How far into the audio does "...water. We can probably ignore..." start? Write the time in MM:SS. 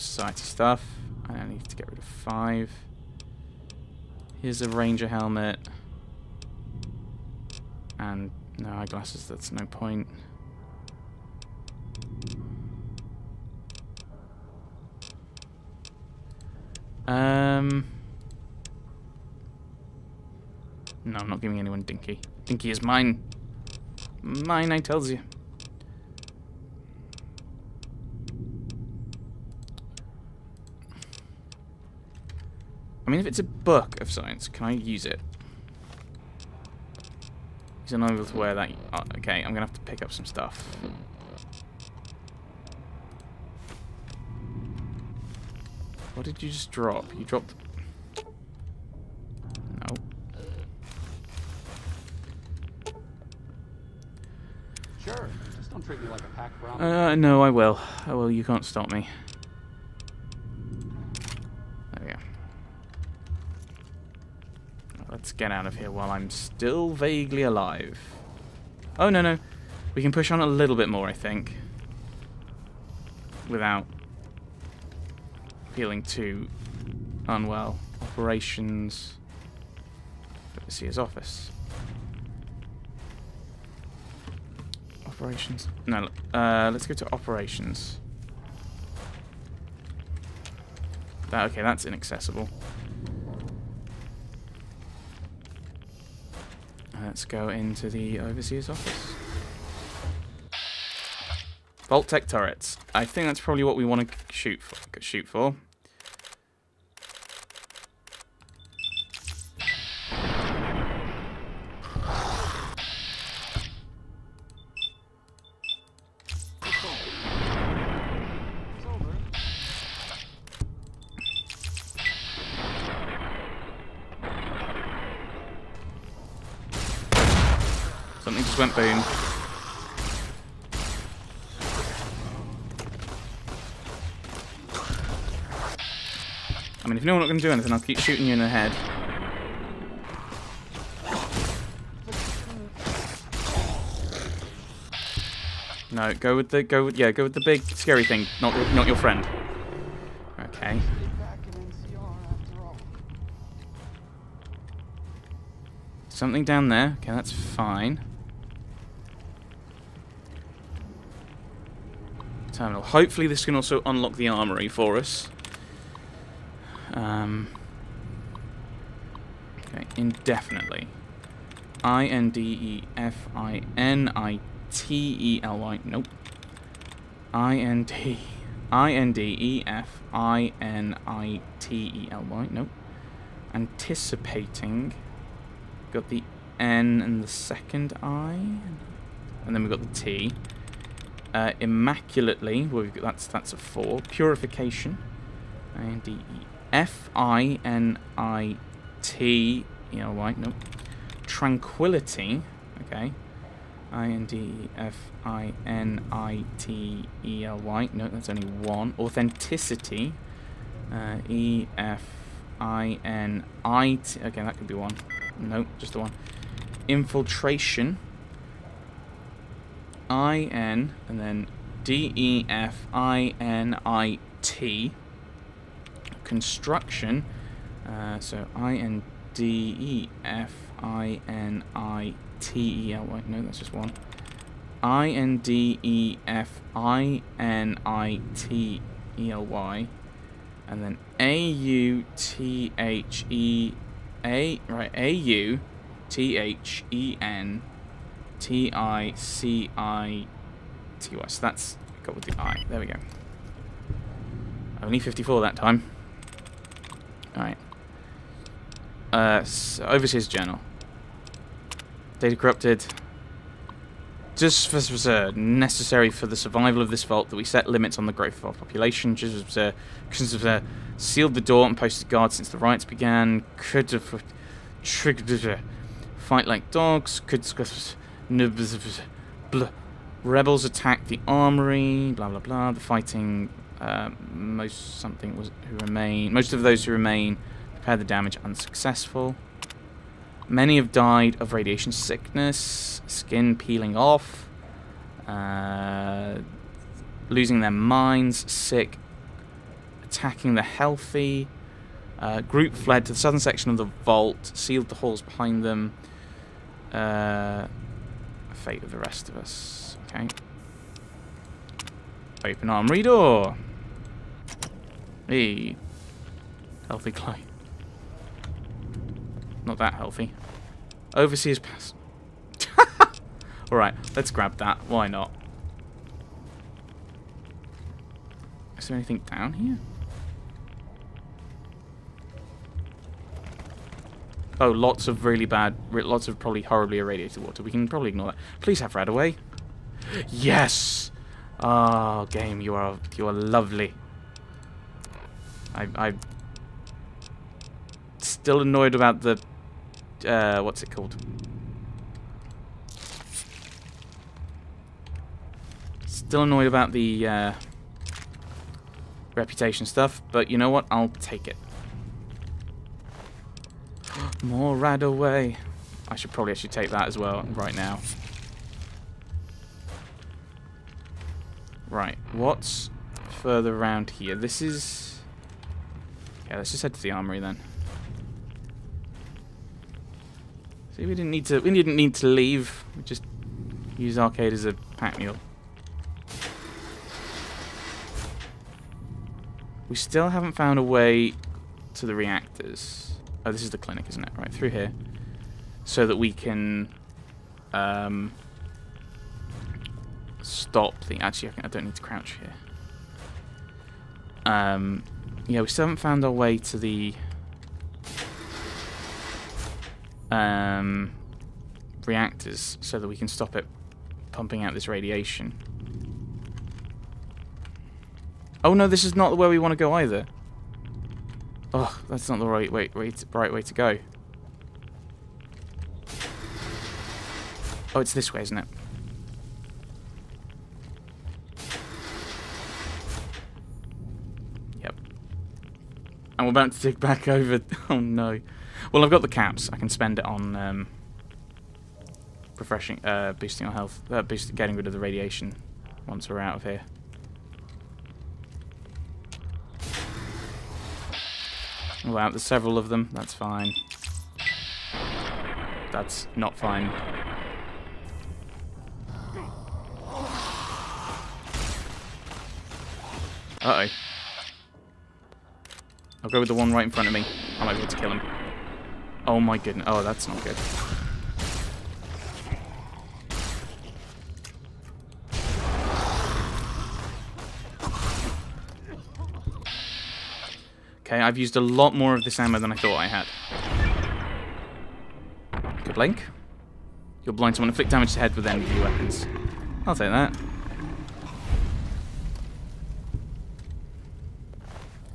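05:37.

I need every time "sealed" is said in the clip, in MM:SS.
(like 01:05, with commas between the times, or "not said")
04:30, 05:04.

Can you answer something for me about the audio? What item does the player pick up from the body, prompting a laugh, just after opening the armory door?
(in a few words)
Overseer's pass.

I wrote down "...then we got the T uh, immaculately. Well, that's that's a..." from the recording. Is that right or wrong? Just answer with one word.
right.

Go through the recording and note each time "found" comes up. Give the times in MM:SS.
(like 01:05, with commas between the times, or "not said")
06:30, 06:45.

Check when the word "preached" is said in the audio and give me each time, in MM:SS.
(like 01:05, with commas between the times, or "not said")
not said.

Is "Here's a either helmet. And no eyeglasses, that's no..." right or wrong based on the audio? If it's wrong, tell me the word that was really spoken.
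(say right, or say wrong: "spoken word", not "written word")
wrong: "ranger", not "either".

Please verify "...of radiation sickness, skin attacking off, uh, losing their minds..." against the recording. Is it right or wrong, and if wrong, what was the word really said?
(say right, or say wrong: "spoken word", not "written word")
wrong: "peeling", not "attacking".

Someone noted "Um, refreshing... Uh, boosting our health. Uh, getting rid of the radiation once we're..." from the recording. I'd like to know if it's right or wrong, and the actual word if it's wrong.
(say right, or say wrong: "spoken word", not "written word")
right.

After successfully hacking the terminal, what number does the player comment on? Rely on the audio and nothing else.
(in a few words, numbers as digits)
54.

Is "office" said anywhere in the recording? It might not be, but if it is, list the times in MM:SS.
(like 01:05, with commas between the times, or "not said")
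01:20, 01:38.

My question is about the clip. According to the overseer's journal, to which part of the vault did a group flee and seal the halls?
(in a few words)
southern section.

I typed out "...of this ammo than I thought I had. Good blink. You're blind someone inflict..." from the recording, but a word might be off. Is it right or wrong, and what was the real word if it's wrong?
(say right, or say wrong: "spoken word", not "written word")
right.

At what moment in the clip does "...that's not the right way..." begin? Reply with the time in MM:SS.
07:02.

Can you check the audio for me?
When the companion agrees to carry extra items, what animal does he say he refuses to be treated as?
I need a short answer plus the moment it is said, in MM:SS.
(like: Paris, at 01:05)
pack Brahmin, at 00:56.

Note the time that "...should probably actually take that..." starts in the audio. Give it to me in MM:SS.
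06:06.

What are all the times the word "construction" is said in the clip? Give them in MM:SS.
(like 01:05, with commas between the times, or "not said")
03:46.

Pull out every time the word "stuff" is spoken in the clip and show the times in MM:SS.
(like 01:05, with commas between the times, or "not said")
00:00, 00:40, 05:59.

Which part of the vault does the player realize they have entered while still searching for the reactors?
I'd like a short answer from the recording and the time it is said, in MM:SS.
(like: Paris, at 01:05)
the clinic, at 06:33.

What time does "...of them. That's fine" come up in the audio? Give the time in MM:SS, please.
07:32.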